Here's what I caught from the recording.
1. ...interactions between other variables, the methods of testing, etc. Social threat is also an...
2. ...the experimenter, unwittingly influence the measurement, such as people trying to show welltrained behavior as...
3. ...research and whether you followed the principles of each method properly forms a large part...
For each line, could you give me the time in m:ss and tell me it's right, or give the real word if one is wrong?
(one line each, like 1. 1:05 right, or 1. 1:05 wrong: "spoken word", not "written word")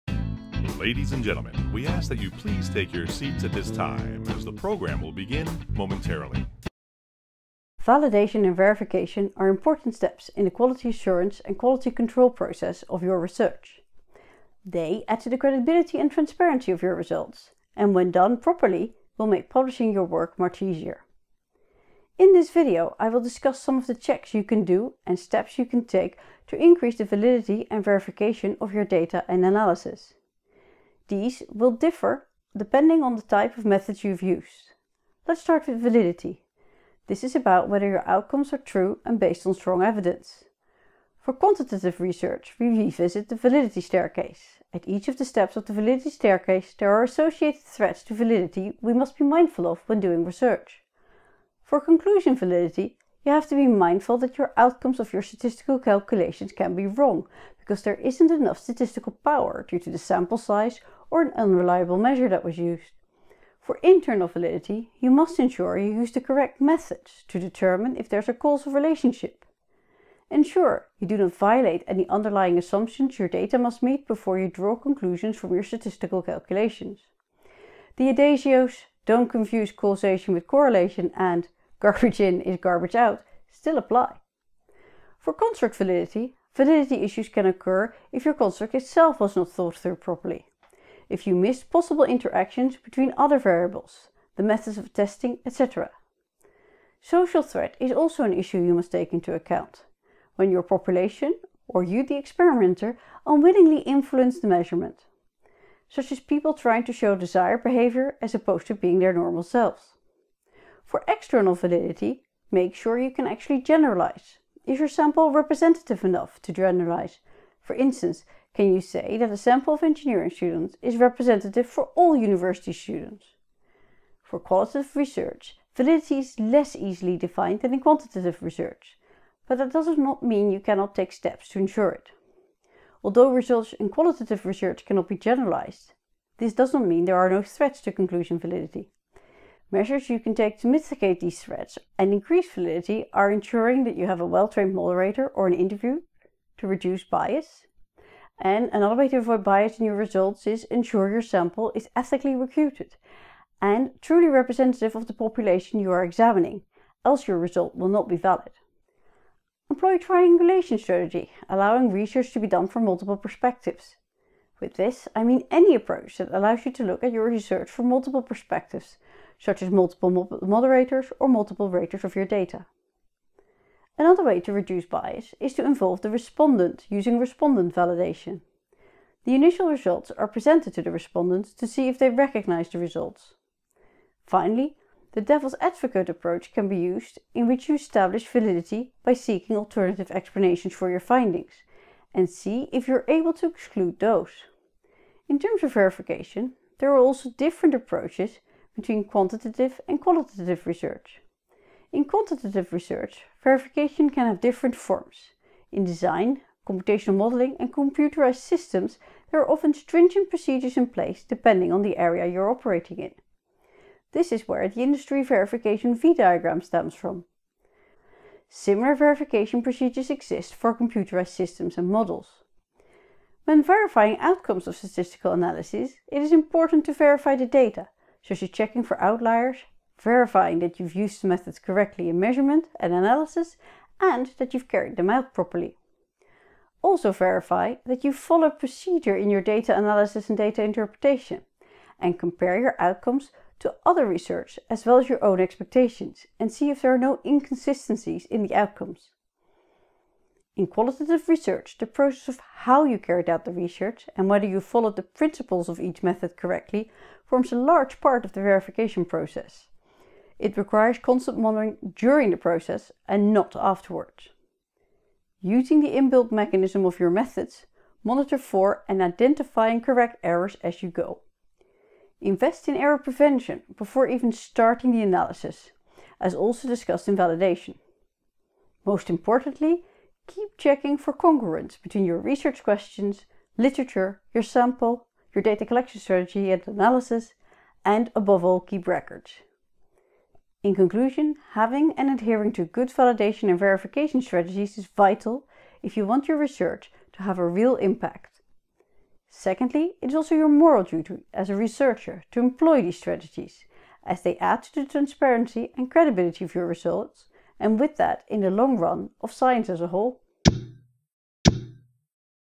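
1. 1:32 right
2. 1:42 wrong: "desired", not "welltrained"
3. 4:13 wrong: "correctly", not "properly".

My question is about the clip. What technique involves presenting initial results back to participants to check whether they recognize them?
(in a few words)
Respondent validation.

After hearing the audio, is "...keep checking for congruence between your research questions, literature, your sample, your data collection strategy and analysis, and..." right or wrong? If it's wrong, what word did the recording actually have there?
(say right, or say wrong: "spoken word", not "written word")
right.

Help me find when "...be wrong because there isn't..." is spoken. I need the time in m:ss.
0:56.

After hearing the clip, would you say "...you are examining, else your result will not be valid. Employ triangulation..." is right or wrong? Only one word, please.
right.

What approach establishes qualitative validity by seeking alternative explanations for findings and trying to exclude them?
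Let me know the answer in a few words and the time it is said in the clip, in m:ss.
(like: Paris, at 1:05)
Devil's advocate approach, at 3:05.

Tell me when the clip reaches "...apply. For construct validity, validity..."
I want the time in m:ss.
1:23.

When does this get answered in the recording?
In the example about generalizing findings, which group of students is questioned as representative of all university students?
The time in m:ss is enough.
1:59.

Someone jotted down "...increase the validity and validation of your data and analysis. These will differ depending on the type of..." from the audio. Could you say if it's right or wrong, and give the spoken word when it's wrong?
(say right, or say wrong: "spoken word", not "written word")
wrong: "verification", not "validation".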